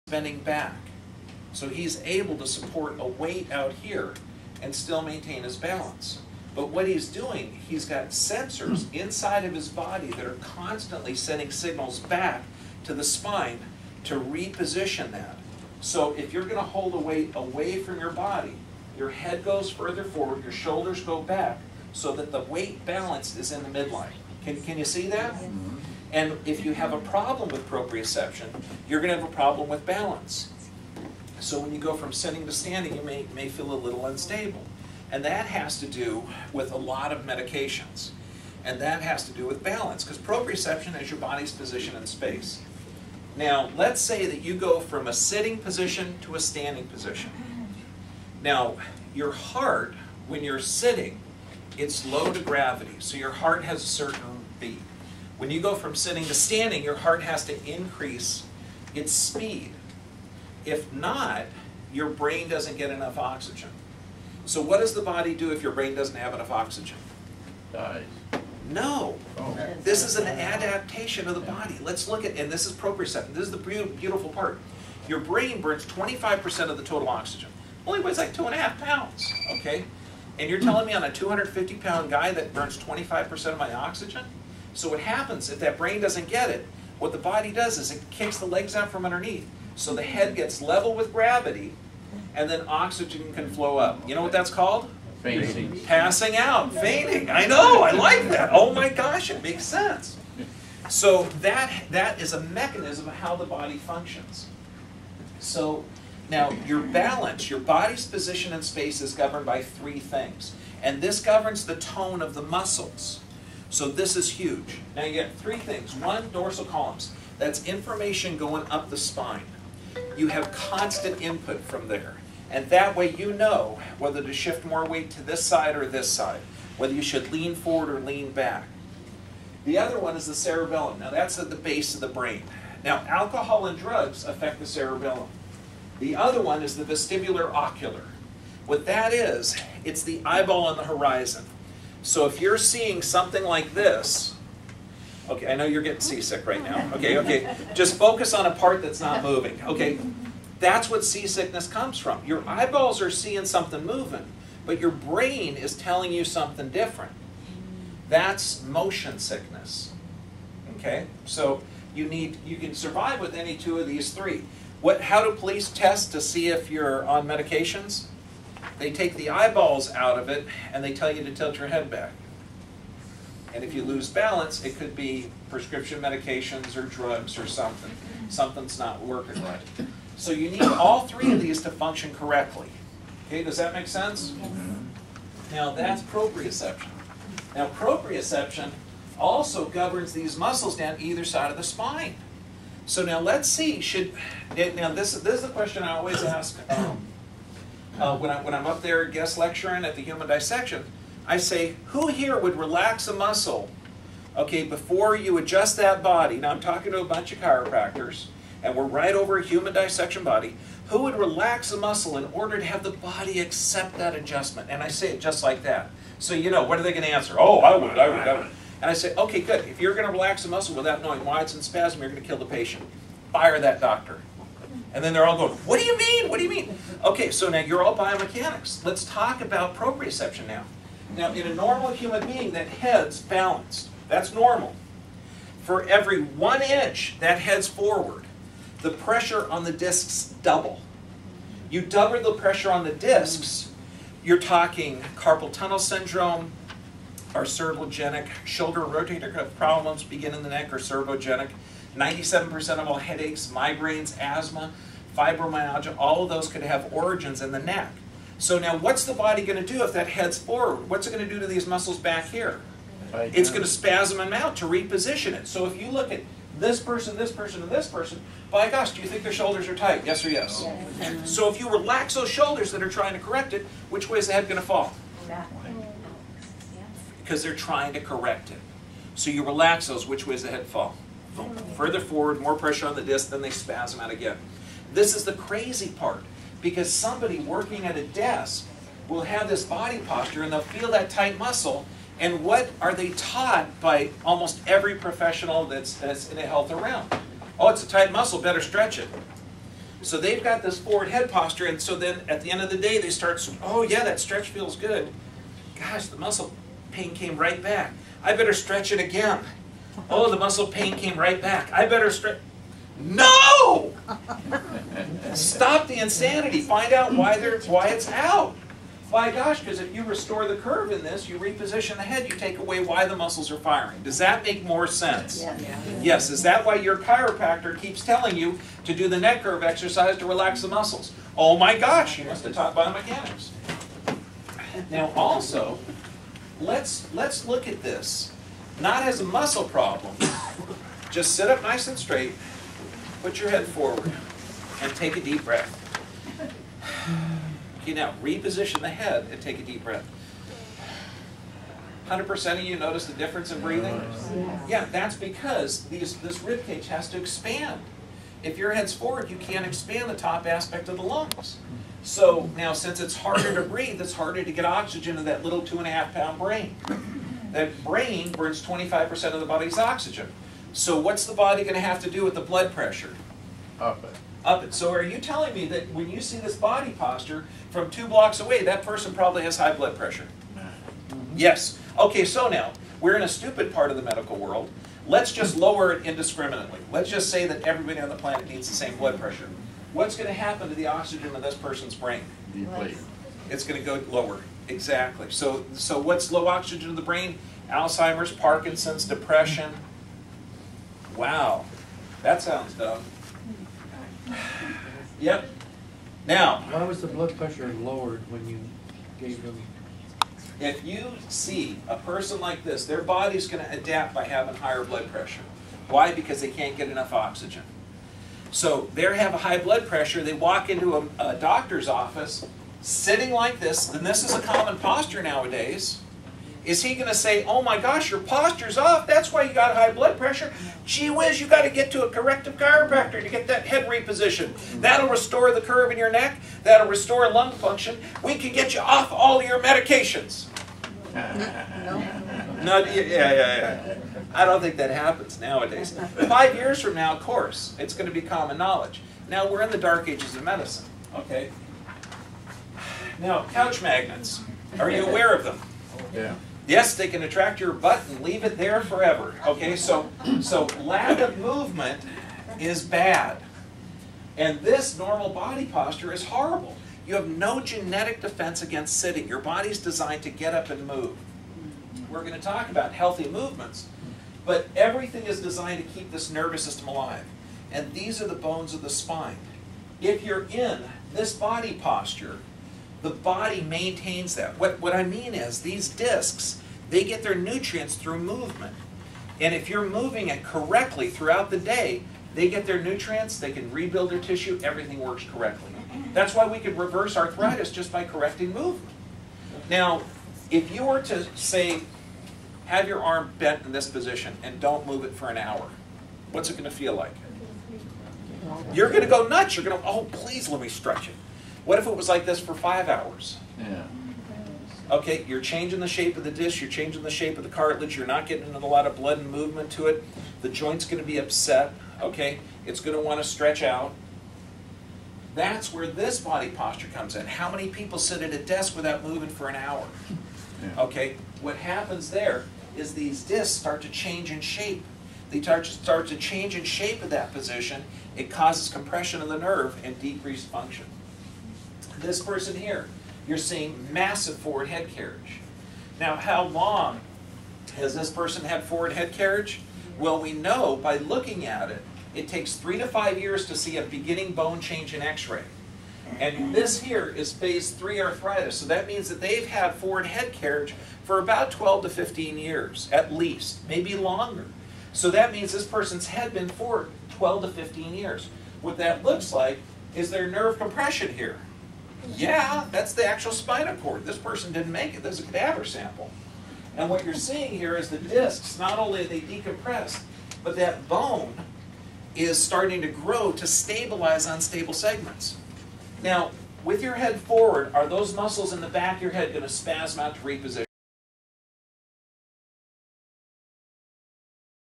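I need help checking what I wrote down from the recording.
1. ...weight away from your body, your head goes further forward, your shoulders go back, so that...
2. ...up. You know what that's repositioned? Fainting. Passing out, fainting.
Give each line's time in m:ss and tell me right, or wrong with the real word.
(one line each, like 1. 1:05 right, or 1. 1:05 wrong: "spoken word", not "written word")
1. 0:16 right
2. 1:33 wrong: "called", not "repositioned".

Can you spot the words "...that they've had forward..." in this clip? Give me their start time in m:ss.
9:19.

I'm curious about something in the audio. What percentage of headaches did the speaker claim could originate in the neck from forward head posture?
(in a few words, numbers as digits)
97%.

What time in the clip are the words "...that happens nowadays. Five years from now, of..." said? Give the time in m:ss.
7:24.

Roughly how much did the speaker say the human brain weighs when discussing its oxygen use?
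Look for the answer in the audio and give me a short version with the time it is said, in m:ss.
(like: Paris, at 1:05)
2.5 pounds, at 1:18.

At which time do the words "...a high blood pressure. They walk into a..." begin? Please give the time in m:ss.
6:59.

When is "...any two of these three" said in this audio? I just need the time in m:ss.
2:43.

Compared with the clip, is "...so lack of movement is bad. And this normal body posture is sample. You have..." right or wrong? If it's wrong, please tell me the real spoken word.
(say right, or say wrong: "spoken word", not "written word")
wrong: "horrible", not "sample".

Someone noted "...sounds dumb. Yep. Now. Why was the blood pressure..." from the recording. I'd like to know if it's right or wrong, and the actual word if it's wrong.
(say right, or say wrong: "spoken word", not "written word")
right.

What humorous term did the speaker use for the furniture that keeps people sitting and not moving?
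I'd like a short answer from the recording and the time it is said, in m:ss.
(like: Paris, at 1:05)
Couch magnets, at 7:33.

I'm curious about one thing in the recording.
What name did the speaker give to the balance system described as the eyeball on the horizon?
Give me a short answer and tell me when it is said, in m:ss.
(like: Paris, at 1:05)
Vestibular ocular, at 2:16.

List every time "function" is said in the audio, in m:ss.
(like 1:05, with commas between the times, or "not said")
1:43, 3:01, 7:17, 9:00.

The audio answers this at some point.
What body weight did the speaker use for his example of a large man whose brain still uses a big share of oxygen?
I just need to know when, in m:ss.
1:21.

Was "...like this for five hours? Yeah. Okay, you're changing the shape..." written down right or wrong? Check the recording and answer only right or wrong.
right.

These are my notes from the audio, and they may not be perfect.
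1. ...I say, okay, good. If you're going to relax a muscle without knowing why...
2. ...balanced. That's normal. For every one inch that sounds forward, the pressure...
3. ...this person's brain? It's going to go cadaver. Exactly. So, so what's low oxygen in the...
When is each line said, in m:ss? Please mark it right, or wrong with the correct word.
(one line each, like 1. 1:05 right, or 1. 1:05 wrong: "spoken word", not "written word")
1. 3:38 right
2. 3:53 wrong: "heads", not "sounds"
3. 6:31 wrong: "lower", not "cadaver".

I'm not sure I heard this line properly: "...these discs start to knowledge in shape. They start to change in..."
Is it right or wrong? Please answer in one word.
wrong.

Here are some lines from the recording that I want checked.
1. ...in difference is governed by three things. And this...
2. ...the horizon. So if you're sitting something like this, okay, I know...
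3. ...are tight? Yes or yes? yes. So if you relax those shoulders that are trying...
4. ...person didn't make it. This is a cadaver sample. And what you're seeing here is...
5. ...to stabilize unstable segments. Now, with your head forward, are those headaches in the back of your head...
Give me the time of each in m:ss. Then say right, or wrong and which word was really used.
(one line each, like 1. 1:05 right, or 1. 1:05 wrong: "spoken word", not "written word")
1. 1:48 wrong: "space", not "difference"
2. 2:20 wrong: "seeing", not "sitting"
3. 4:29 right
4. 9:34 right
5. 9:43 wrong: "muscles", not "headaches".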